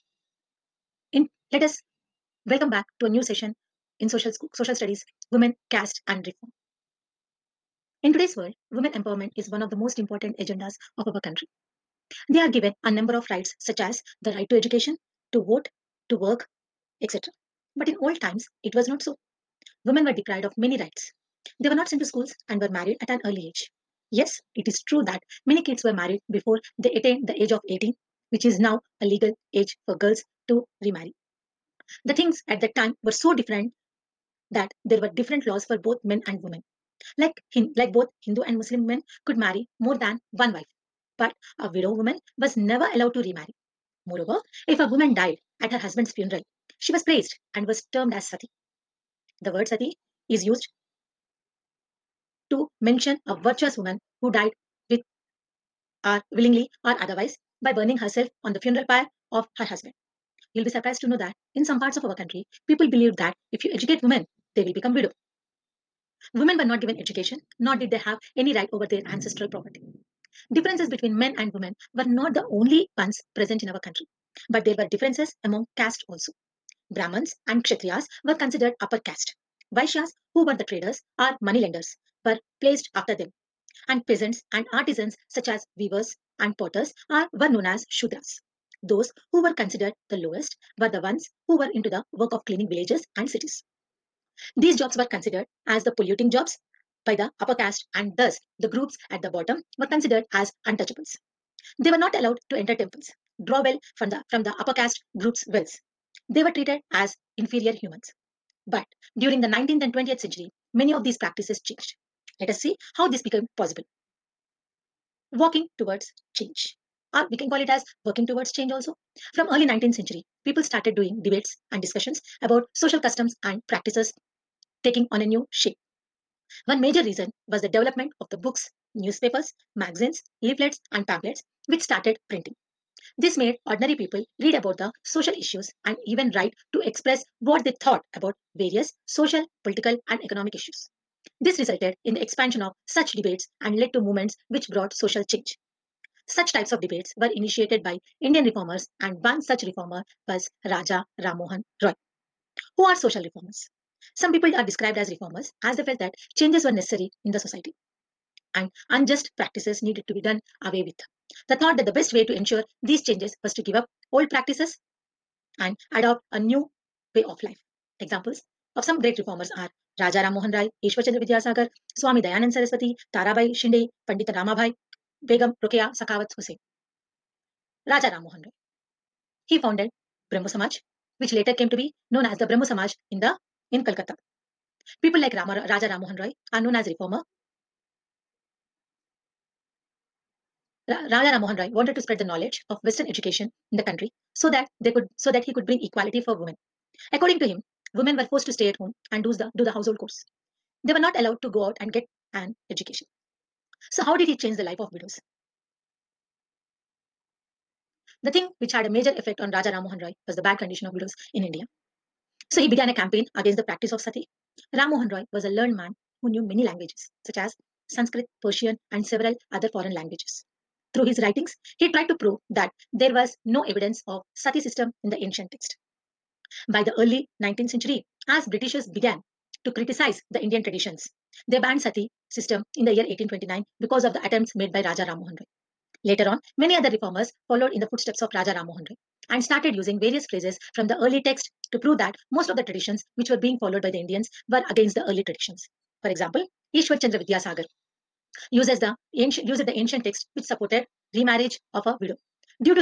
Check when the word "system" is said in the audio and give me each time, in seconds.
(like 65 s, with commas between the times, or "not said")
224 s, 232 s.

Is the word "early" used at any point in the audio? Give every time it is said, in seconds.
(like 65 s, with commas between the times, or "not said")
23 s, 119 s, 226 s, 240 s, 245 s.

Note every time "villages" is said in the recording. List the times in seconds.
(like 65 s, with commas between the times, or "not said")
92 s.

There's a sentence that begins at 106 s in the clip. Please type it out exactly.
They were treated as inferior humans.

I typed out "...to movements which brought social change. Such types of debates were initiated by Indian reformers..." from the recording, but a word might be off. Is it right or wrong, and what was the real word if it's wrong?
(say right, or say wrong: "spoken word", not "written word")
right.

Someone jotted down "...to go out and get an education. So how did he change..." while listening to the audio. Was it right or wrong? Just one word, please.
right.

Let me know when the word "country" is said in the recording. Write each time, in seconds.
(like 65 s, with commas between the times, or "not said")
11 s, 62 s, 73 s, 193 s.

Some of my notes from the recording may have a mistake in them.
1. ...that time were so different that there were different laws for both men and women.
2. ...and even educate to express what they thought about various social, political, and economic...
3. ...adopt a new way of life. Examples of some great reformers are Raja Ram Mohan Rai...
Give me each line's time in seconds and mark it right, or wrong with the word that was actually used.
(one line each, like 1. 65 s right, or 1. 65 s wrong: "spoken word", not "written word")
1. 32 s right
2. 135 s wrong: "write", not "educate"
3. 165 s right.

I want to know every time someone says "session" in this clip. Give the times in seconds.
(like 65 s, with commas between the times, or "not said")
3 s.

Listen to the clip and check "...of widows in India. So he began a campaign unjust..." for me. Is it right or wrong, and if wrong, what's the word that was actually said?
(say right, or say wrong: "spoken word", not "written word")
wrong: "against", not "unjust".